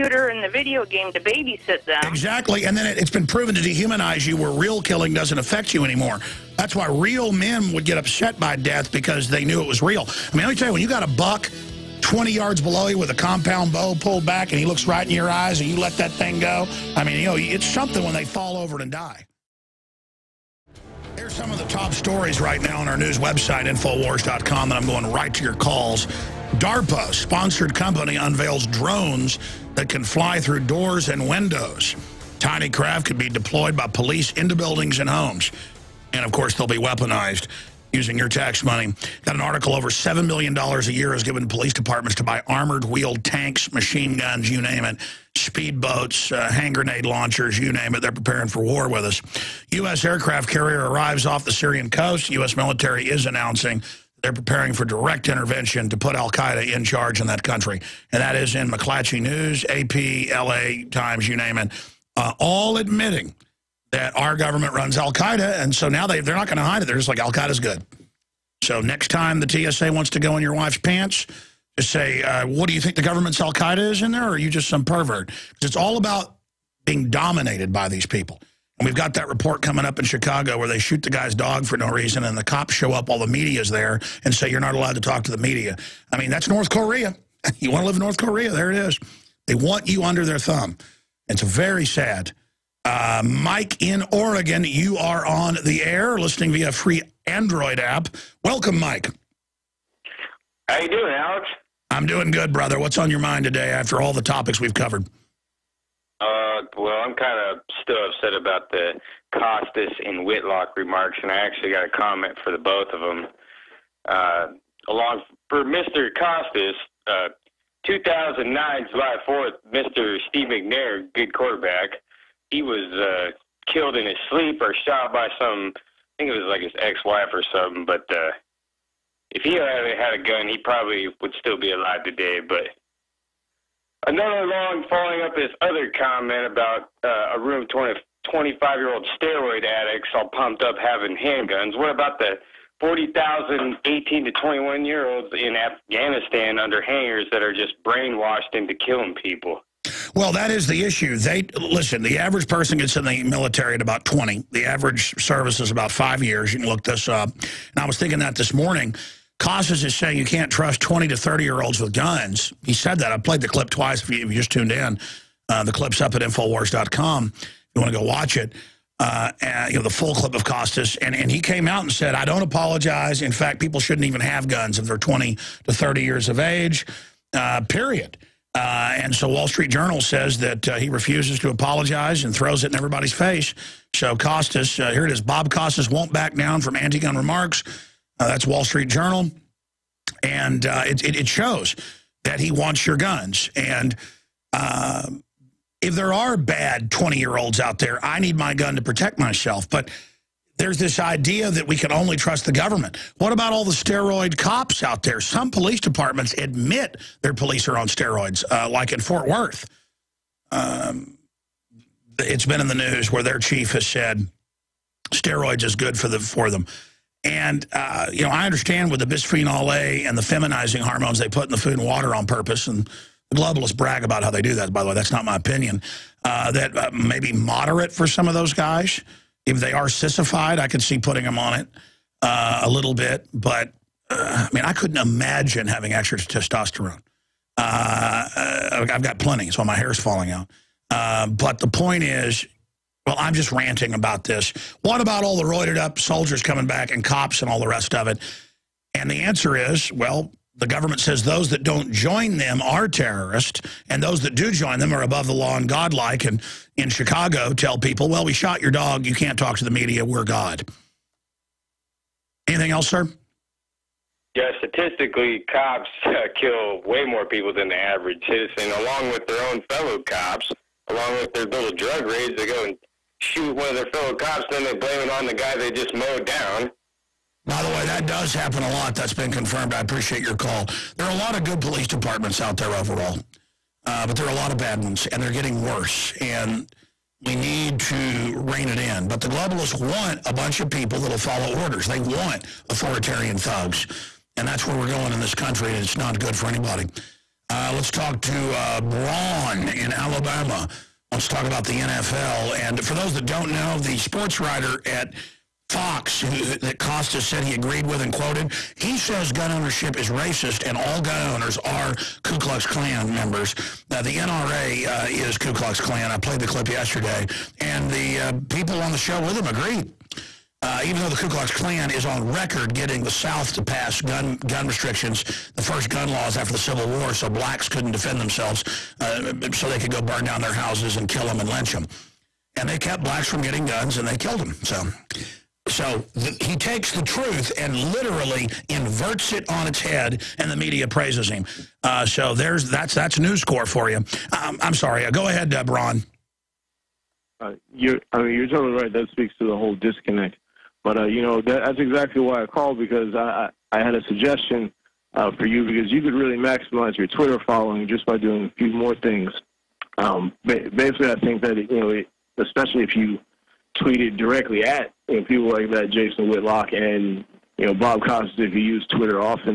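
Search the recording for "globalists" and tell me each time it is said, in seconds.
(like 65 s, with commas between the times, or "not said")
223 s, 289 s.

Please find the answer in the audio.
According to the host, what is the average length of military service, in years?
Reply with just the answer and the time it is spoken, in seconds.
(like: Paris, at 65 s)
5, at 155 s.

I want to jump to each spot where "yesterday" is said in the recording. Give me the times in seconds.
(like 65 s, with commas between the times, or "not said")
316 s.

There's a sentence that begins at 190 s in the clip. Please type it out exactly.
And uh, it, it, it, shows that he wants your guns.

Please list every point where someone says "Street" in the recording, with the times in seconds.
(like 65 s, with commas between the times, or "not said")
179 s, 188 s.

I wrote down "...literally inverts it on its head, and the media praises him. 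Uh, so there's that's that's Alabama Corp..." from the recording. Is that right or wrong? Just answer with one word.
wrong.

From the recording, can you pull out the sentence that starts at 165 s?
Uh, the clip's up at Infowars.com.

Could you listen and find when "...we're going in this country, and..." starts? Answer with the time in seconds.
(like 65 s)
294 s.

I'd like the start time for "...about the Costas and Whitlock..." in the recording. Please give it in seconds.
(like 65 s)
108 s.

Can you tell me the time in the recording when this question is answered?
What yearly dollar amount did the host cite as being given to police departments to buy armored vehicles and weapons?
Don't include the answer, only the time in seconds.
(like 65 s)
39 s.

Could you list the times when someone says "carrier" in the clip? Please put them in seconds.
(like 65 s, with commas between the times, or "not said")
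50 s.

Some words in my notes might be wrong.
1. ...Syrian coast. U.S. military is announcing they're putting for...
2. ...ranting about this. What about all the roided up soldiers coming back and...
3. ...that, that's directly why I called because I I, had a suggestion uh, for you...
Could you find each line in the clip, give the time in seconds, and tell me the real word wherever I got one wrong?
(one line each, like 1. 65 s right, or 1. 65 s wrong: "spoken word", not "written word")
1. 51 s wrong: "preparing", not "putting"
2. 243 s right
3. 351 s wrong: "exactly", not "directly".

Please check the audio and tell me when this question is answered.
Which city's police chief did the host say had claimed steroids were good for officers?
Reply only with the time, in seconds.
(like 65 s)
209 s.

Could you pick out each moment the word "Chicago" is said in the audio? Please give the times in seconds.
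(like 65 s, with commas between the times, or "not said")
80 s, 256 s.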